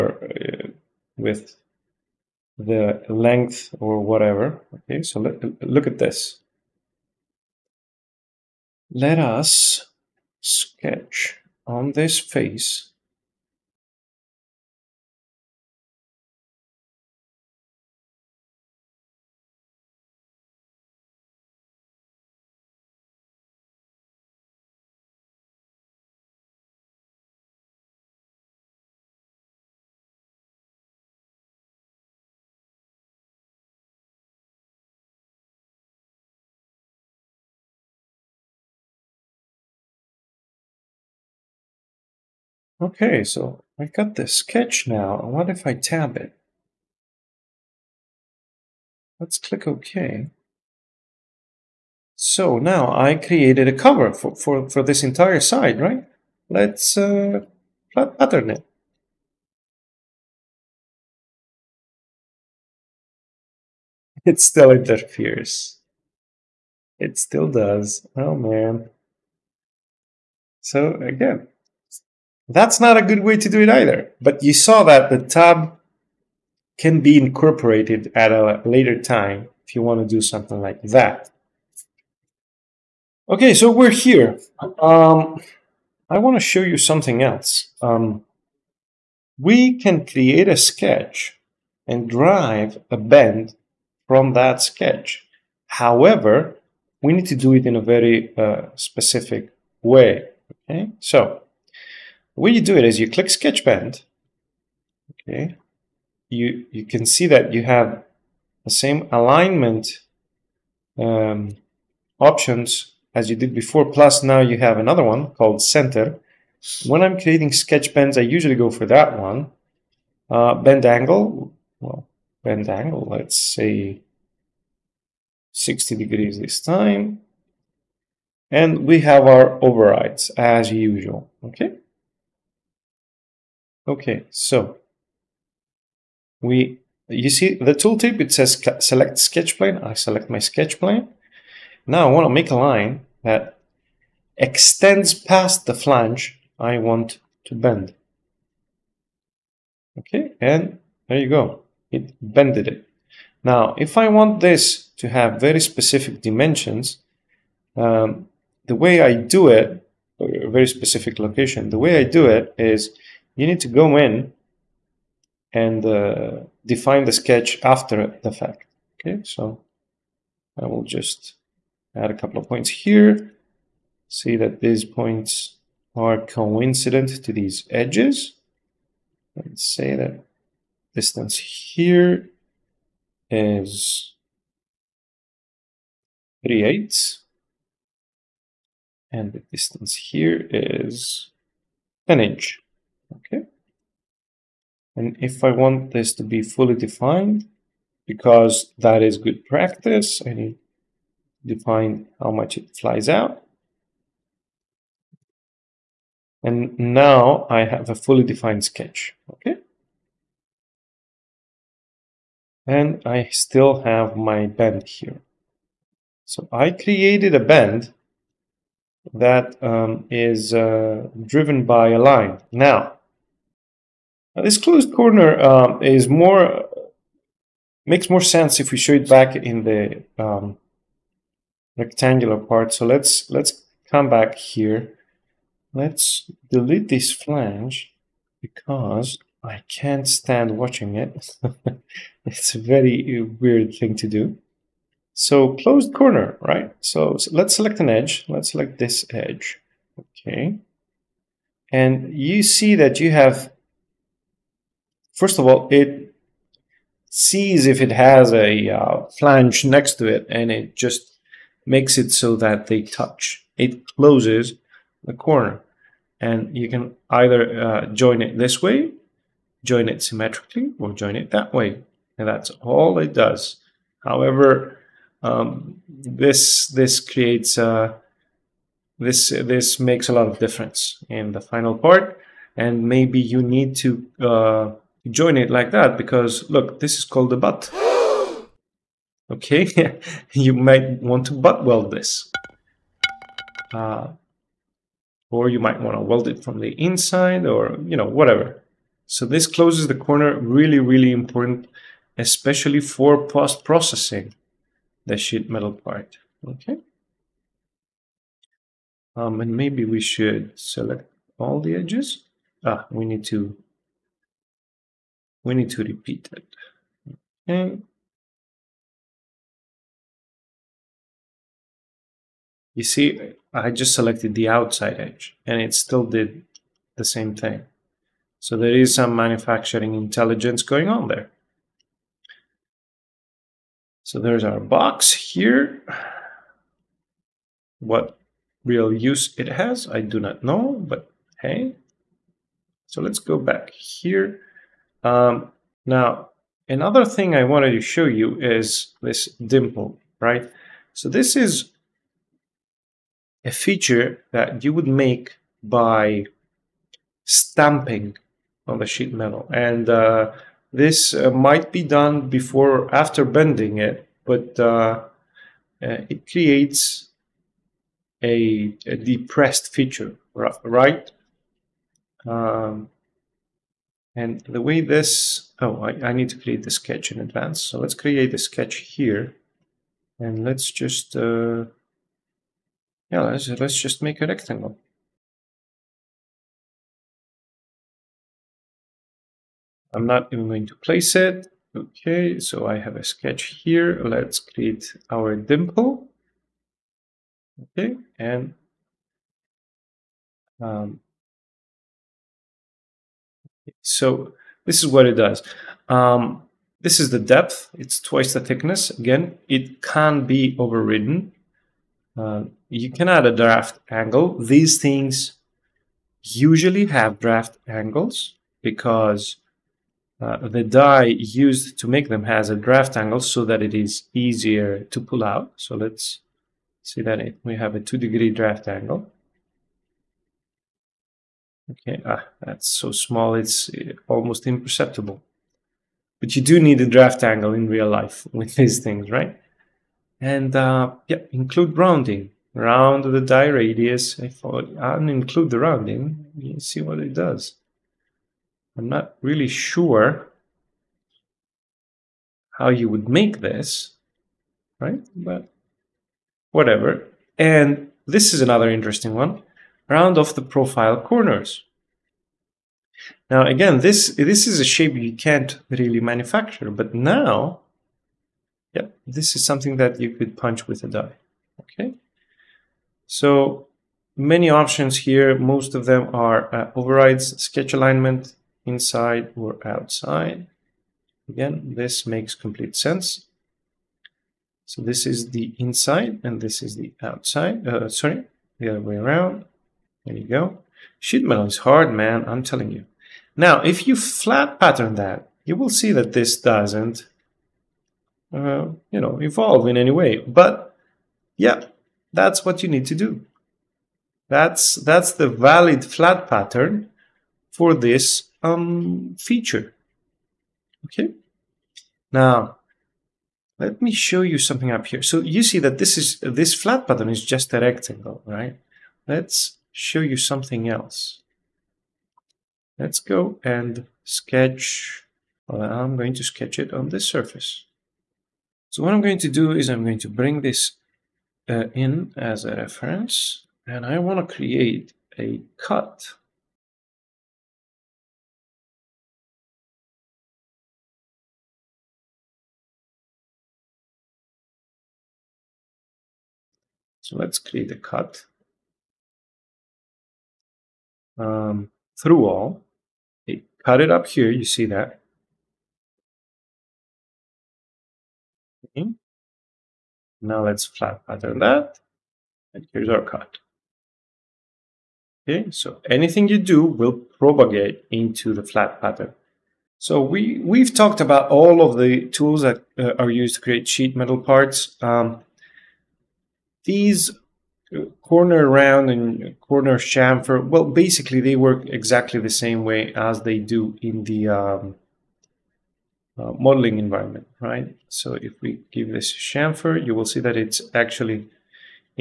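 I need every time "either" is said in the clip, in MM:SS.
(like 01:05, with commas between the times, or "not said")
01:13, 04:27.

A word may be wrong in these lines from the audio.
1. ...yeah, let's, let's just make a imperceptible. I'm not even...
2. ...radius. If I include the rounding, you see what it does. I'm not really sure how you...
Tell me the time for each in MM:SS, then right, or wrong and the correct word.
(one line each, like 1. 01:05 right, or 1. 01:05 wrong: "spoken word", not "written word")
1. 06:23 wrong: "rectangle", not "imperceptible"
2. 07:23 right.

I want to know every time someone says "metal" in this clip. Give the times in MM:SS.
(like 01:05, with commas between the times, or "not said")
05:05, 05:59, 08:11, 09:33.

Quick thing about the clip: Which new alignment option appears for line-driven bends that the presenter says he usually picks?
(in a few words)
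Center.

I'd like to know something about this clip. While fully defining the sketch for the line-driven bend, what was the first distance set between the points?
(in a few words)
3/8.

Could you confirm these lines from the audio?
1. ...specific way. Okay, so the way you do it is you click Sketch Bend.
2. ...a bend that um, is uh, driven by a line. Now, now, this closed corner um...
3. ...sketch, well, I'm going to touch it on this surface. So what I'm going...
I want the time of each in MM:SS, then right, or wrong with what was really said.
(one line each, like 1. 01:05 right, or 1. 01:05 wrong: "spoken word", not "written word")
1. 01:38 right
2. 03:37 right
3. 08:44 wrong: "sketch", not "touch".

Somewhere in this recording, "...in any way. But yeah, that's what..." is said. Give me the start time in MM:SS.
08:19.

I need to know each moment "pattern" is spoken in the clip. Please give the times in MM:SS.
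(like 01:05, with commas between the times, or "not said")
00:57, 08:14, 08:26, 08:36, 09:21, 09:28.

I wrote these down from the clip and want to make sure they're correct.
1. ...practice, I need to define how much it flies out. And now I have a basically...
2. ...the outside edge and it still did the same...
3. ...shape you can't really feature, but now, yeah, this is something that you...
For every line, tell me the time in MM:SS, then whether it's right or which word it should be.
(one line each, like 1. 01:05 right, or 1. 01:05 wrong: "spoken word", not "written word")
1. 03:19 wrong: "fully", not "basically"
2. 05:24 right
3. 07:44 wrong: "manufacture", not "feature".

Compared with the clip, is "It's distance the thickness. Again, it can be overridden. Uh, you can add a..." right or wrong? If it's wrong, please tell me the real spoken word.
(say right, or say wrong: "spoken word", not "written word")
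wrong: "twice", not "distance".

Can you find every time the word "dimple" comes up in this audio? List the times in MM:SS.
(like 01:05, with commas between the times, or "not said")
05:49, 06:35.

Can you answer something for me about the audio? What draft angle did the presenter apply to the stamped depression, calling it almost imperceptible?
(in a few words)
2 degrees.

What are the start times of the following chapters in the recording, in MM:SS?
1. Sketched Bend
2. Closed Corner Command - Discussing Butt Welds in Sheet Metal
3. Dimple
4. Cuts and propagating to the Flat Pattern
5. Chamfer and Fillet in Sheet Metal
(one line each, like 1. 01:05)
1. 01:25
2. 03:55
3. 05:48
4. 08:33
5. 09:34.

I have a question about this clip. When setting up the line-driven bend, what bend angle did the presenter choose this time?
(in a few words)
60 degrees.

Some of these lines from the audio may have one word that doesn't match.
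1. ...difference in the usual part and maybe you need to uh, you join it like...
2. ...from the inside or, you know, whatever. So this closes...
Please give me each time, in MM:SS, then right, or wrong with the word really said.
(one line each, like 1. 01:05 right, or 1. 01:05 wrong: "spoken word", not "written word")
1. 04:40 wrong: "final", not "usual"
2. 04:56 right.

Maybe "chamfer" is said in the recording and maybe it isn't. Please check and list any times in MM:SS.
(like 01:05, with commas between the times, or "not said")
09:39, 09:49.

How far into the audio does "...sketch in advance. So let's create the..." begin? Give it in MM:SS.
06:16.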